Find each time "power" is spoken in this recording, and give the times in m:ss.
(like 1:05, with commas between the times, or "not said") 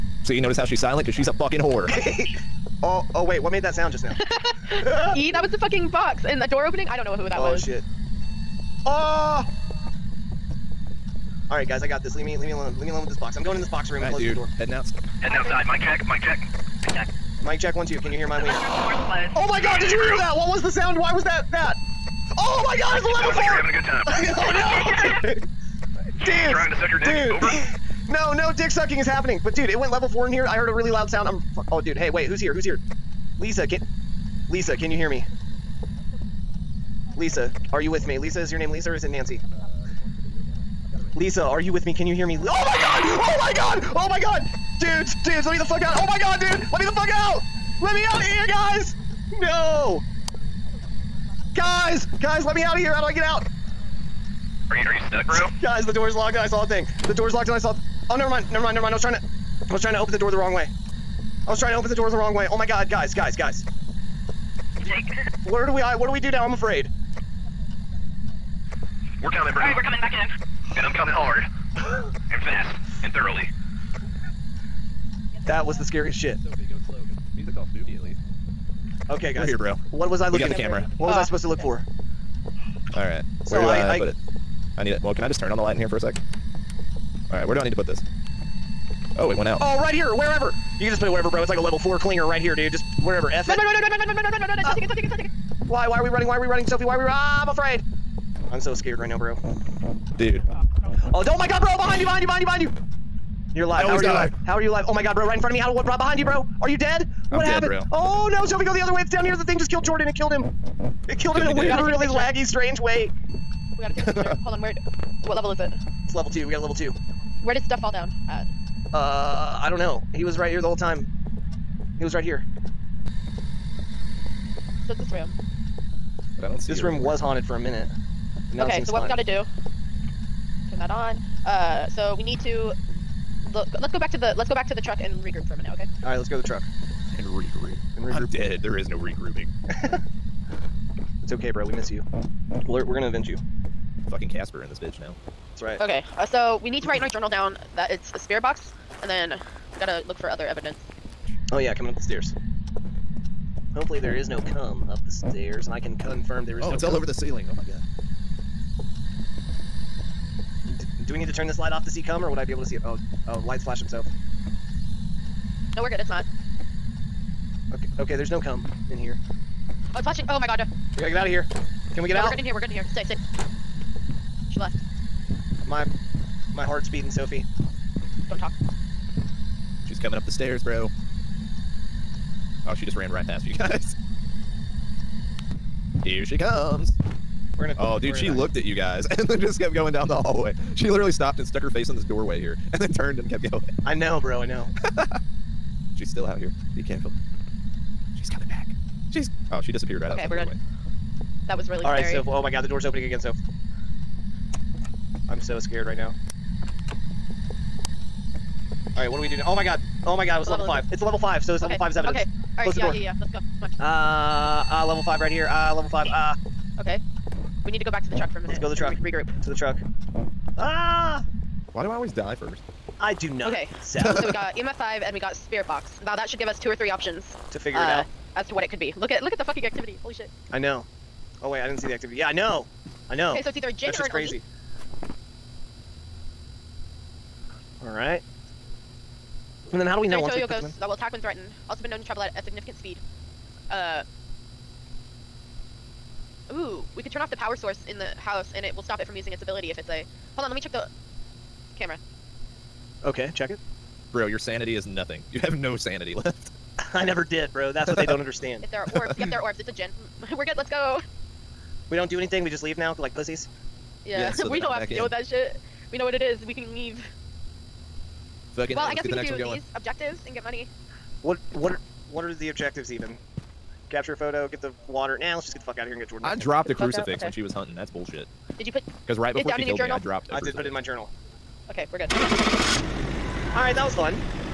4:07.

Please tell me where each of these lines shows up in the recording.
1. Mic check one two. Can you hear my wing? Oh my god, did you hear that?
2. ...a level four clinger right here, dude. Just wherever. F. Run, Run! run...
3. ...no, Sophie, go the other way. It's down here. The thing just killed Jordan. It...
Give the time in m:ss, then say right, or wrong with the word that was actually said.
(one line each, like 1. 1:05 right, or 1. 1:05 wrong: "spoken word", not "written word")
1. 0:17 right
2. 1:31 right
3. 1:48 right.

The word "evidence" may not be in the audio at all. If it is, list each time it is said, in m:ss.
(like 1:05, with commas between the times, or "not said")
2:30, 3:31.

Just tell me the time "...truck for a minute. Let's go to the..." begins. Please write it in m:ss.
3:38.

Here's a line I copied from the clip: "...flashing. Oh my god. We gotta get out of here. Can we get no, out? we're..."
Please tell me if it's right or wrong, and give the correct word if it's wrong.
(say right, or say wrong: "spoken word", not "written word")
right.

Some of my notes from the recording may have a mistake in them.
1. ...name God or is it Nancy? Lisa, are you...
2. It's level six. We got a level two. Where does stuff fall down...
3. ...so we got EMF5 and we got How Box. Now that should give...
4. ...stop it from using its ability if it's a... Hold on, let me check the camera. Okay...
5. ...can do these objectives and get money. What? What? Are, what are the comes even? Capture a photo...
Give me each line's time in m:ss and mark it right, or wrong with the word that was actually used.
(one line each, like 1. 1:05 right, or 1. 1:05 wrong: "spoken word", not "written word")
1. 0:38 wrong: "Lisa", not "God"
2. 1:56 wrong: "two", not "six"
3. 3:43 wrong: "Spirit", not "How"
4. 4:08 right
5. 4:29 wrong: "objectives", not "comes".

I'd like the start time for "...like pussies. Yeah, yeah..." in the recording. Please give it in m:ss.
4:22.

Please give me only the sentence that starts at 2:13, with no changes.
Look, let's go back to the let's go back to the truck and regroup for a minute, okay?